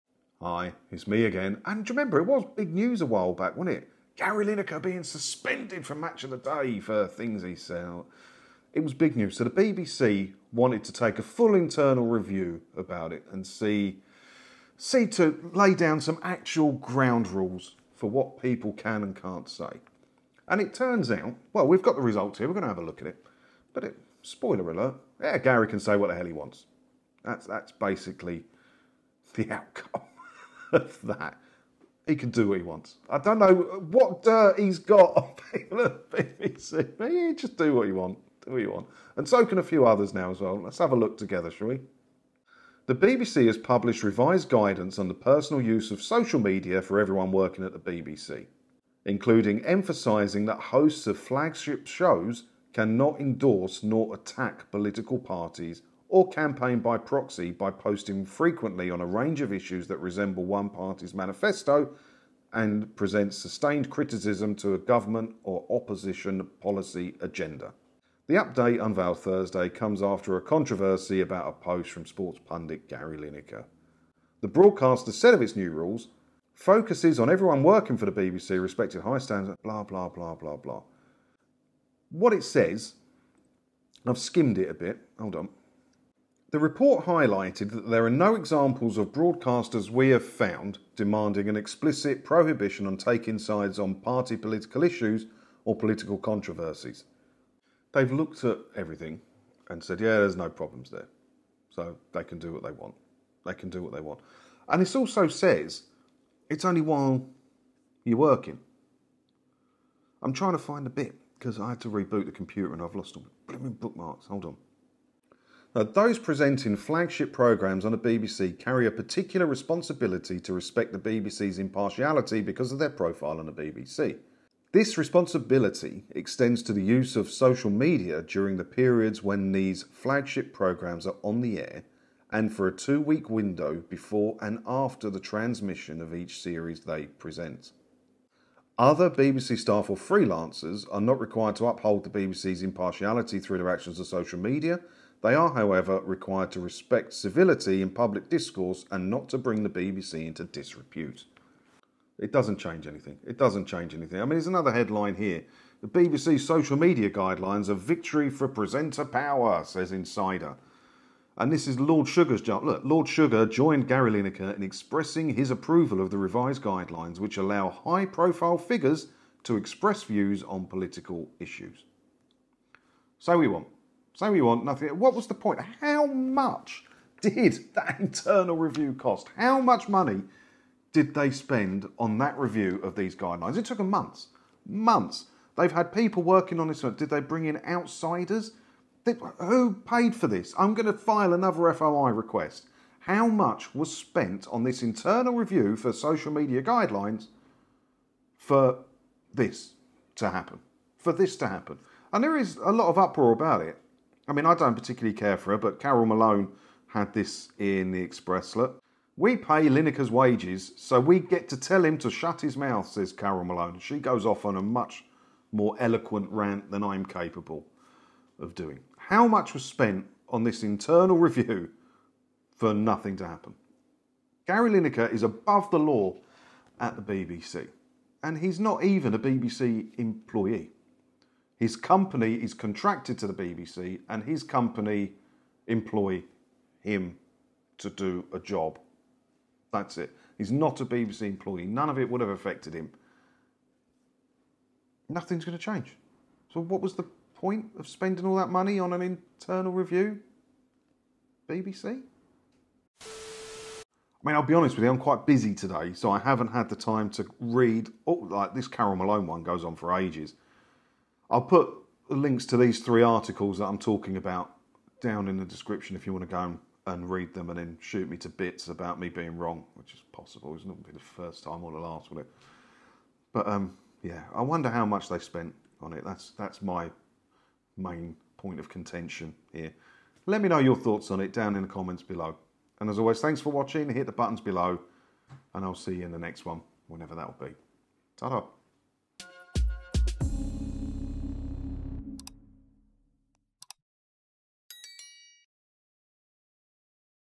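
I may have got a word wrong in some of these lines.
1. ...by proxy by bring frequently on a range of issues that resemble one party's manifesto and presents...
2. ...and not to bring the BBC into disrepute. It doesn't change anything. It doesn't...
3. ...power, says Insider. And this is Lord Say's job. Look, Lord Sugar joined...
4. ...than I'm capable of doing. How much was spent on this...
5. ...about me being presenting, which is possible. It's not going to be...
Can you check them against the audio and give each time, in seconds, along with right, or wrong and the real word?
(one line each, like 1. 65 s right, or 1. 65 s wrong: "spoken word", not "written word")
1. 56 s wrong: "posting", not "bring"
2. 148 s right
3. 159 s wrong: "Sugar", not "Say"
4. 216 s right
5. 268 s wrong: "wrong", not "presenting".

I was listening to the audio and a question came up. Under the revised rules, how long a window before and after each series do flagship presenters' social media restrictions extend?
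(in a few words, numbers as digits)
two week.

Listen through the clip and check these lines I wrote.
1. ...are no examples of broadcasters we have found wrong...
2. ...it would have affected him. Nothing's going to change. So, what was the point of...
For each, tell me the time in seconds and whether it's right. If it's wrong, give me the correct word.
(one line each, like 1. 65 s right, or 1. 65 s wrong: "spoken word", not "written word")
1. 88 s wrong: "demanding", not "wrong"
2. 241 s right.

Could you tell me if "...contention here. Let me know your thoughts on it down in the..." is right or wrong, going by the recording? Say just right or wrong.
right.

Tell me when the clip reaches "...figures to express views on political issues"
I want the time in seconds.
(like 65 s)
168 s.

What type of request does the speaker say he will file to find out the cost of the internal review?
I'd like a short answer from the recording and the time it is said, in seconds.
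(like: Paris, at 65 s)
FOI request, at 191 s.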